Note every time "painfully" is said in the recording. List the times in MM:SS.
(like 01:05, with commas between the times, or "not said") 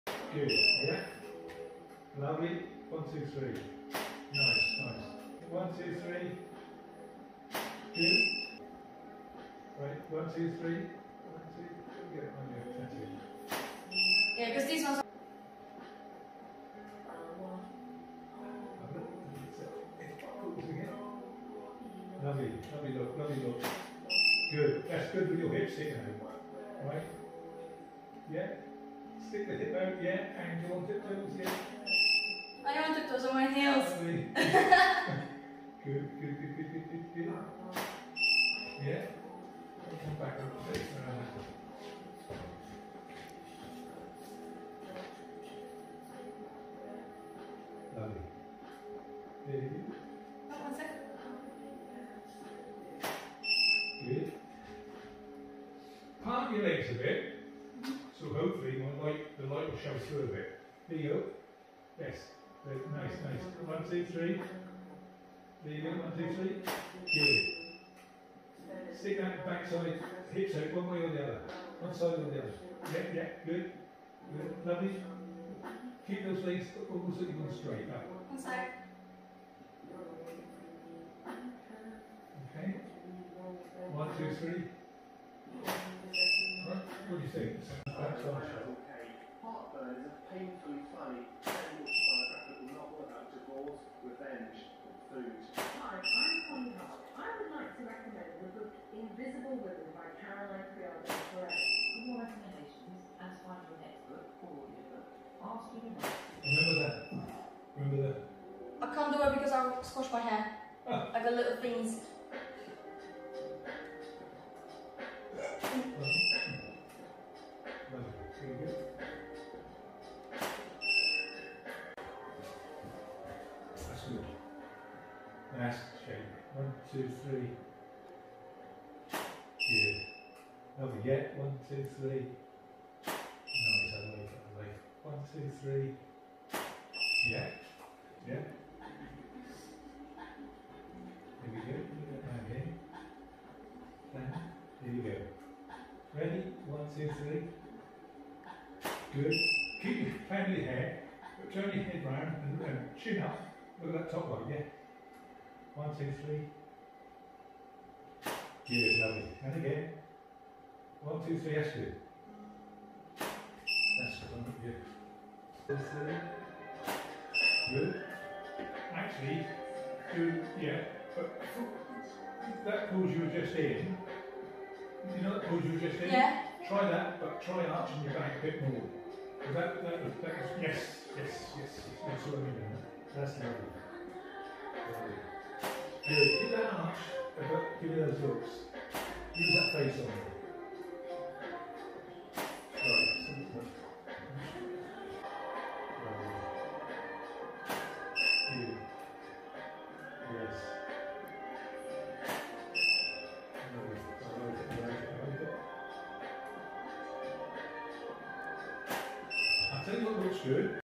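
01:30.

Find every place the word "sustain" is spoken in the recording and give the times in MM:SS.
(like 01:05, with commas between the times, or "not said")
not said.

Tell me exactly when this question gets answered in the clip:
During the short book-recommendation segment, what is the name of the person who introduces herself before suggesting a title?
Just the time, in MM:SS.
01:36.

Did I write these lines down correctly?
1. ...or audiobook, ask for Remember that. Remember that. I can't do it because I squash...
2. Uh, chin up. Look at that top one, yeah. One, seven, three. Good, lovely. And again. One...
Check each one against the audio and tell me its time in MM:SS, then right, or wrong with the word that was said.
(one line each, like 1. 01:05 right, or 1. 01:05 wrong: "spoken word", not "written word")
1. 01:44 right
2. 02:32 wrong: "two", not "seven".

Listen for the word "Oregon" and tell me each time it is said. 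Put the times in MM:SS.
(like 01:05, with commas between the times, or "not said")
not said.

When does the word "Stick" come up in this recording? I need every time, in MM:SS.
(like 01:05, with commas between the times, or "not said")
00:29, 01:08.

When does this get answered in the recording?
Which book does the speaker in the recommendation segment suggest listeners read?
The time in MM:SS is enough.
01:38.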